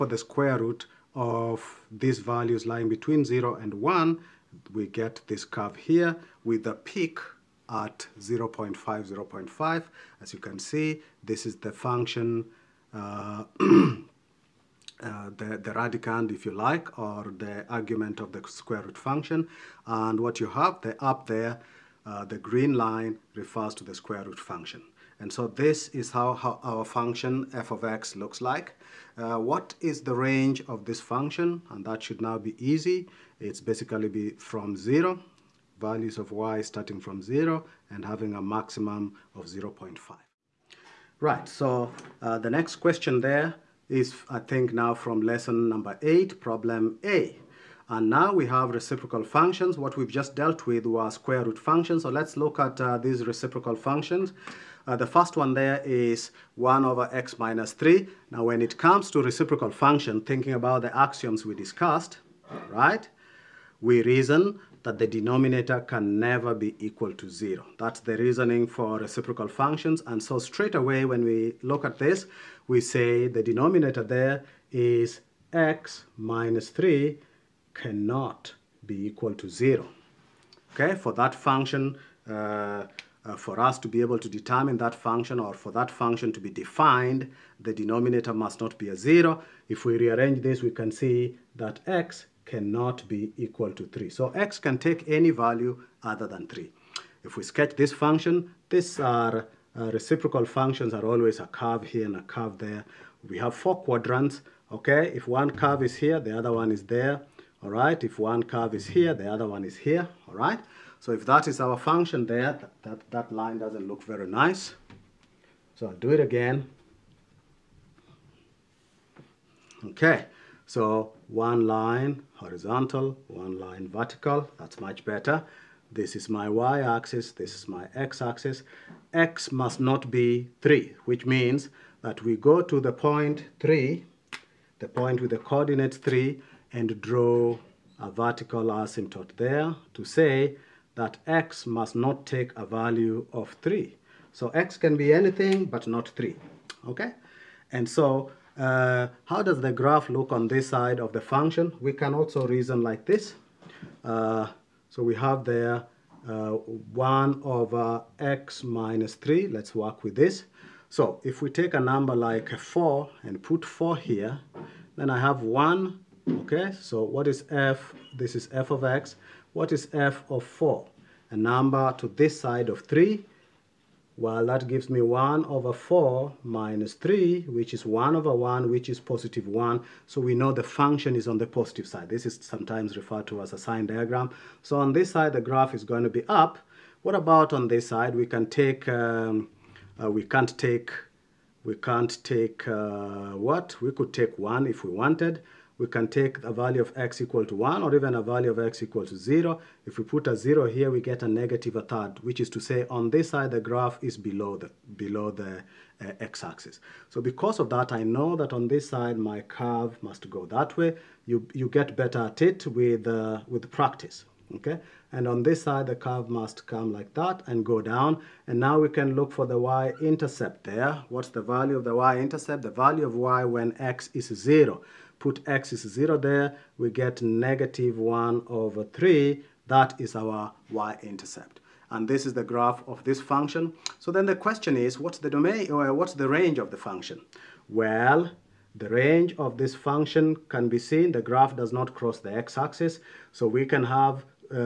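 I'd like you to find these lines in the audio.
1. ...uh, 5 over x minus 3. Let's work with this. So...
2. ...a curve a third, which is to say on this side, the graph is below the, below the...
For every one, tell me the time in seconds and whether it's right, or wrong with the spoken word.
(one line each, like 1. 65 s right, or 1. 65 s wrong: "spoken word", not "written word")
1. 156 s wrong: "1", not "5"
2. 201 s wrong: "negative", not "curve".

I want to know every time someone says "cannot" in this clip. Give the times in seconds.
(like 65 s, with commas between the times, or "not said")
77 s, 92 s.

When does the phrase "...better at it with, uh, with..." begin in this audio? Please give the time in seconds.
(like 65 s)
211 s.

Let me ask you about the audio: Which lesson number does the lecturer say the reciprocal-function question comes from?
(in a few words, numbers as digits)
8.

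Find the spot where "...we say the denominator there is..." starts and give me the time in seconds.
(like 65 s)
72 s.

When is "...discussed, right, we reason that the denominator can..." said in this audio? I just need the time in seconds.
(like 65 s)
61 s.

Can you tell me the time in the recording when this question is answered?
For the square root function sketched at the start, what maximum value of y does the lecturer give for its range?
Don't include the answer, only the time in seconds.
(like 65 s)
38 s.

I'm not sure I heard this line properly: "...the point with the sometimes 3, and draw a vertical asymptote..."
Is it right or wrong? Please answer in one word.
wrong.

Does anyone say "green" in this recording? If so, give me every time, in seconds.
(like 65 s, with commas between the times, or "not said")
22 s.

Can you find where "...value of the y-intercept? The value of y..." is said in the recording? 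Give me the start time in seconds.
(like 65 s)
221 s.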